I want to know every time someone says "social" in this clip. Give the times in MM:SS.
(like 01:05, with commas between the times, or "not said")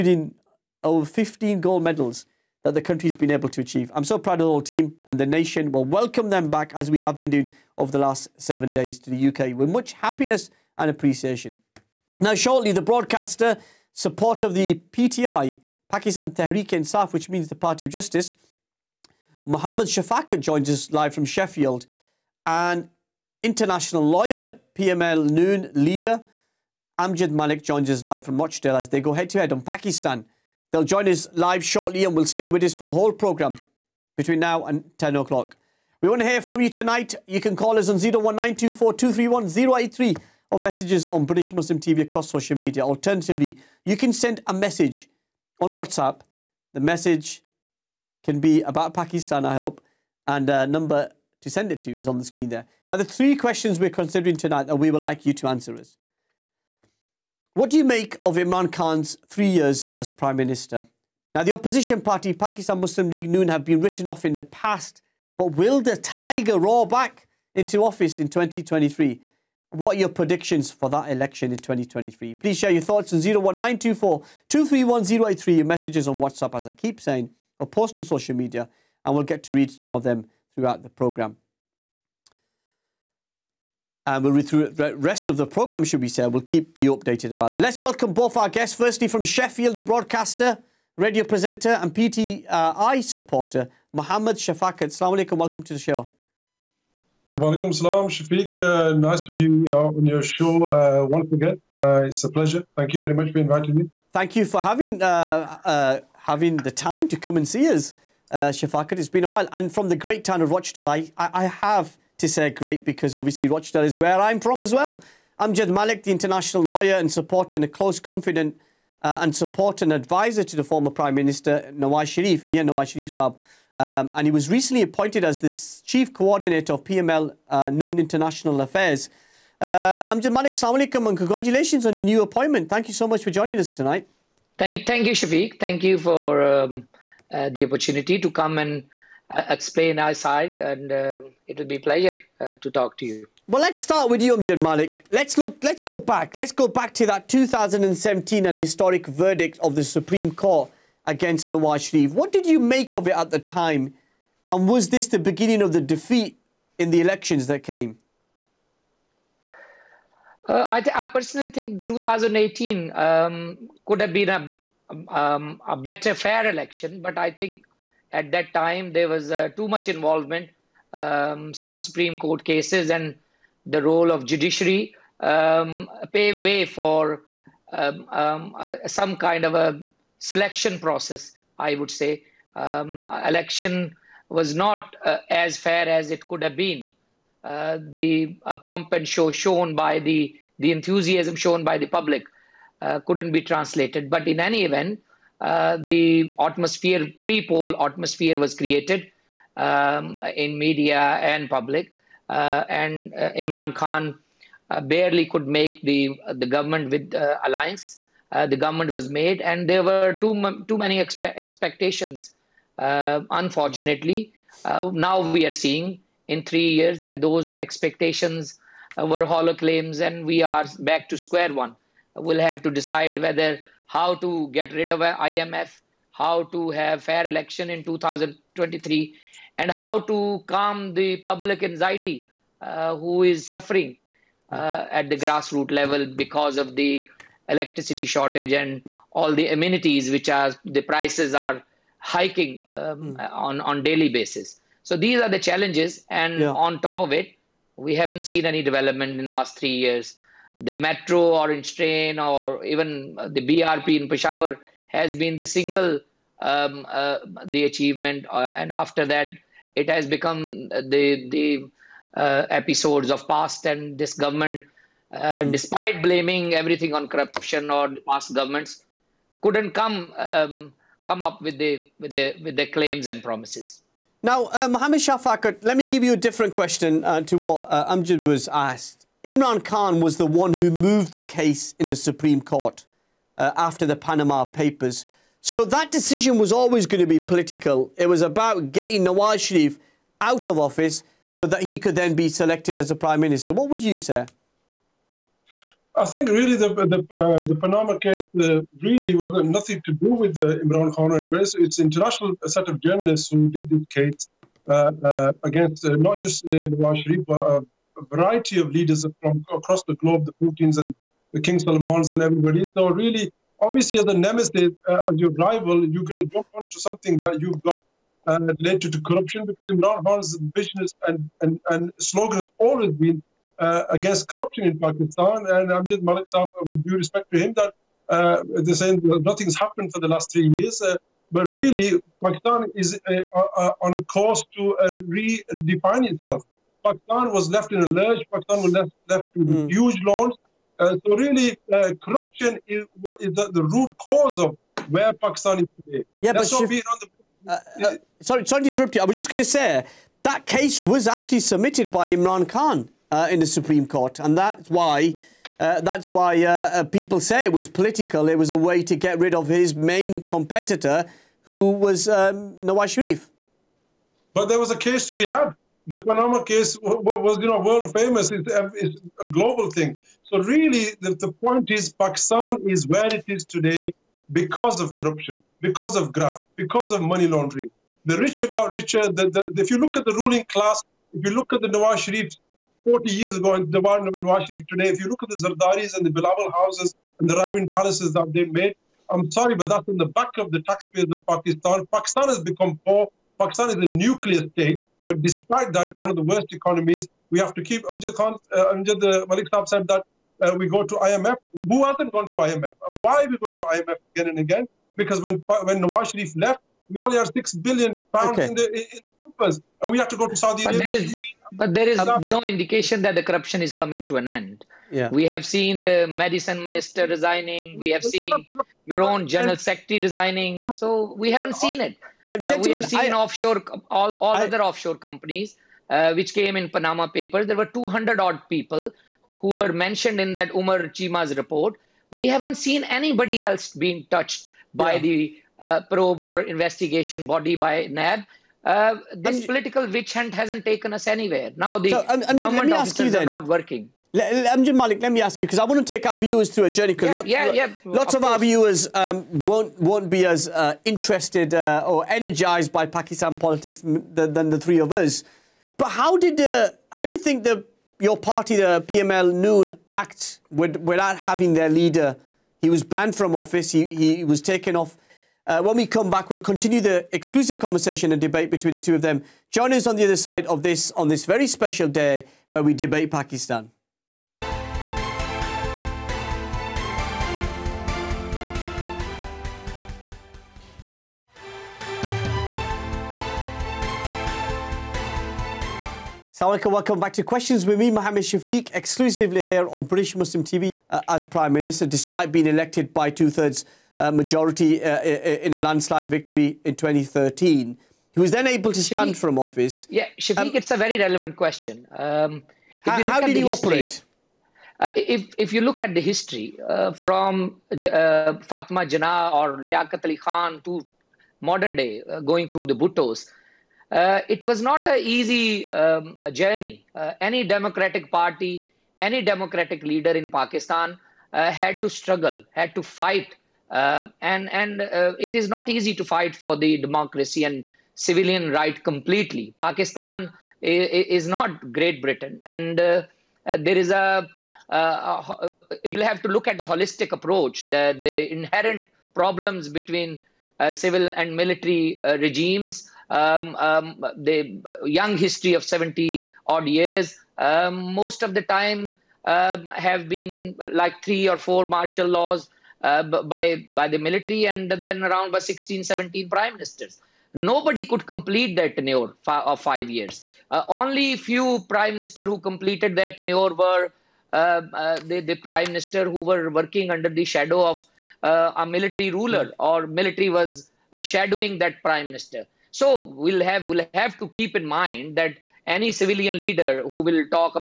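00:42, 01:18.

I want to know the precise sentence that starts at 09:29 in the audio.
or military was shadowing that prime minister.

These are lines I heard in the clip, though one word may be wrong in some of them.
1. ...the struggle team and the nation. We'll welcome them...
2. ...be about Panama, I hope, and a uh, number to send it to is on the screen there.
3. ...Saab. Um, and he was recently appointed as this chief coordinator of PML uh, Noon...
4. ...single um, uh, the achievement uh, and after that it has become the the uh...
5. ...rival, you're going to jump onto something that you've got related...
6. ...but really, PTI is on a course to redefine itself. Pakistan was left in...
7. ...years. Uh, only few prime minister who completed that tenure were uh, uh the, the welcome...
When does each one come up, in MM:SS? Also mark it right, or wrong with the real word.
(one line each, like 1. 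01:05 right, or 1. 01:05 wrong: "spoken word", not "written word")
1. 00:04 wrong: "whole", not "struggle"
2. 00:48 wrong: "Pakistan", not "Panama"
3. 02:03 right
4. 04:15 right
5. 05:15 right
6. 05:31 wrong: "Pakistan", not "PTI"
7. 09:19 wrong: "prime", not "welcome".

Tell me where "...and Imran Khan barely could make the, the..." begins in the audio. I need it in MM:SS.
03:22.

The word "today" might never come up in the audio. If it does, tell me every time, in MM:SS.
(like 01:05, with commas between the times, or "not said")
05:45, 06:13, 06:24.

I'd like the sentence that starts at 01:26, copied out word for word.
We'll keep you updated about it.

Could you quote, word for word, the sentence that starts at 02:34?
And was this the beginning of the defeat in the elections that came?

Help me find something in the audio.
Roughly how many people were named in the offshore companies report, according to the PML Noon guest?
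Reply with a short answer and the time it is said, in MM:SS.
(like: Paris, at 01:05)
200, at 07:07.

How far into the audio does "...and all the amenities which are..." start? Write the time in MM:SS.
03:58.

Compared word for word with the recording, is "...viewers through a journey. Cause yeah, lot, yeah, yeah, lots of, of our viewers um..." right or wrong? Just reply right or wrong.
right.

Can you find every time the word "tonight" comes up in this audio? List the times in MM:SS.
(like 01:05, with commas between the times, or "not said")
00:36, 00:54, 02:13.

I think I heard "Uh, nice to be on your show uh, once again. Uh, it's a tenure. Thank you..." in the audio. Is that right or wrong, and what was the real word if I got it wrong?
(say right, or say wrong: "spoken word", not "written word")
wrong: "pleasure", not "tenure".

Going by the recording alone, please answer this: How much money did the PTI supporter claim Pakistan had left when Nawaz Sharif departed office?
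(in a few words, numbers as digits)
6 billion pounds.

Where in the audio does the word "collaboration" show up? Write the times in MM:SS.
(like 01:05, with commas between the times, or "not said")
not said.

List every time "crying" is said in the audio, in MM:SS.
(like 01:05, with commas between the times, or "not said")
not said.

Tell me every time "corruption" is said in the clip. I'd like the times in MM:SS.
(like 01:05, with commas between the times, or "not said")
04:27, 05:19, 05:24, 05:42, 06:14, 06:53.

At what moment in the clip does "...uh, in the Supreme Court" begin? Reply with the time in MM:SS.
05:53.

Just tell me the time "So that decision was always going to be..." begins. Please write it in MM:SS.
04:45.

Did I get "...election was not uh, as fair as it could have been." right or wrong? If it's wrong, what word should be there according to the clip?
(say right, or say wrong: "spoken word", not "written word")
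right.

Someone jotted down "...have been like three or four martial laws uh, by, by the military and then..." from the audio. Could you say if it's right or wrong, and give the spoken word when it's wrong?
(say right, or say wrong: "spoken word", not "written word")
right.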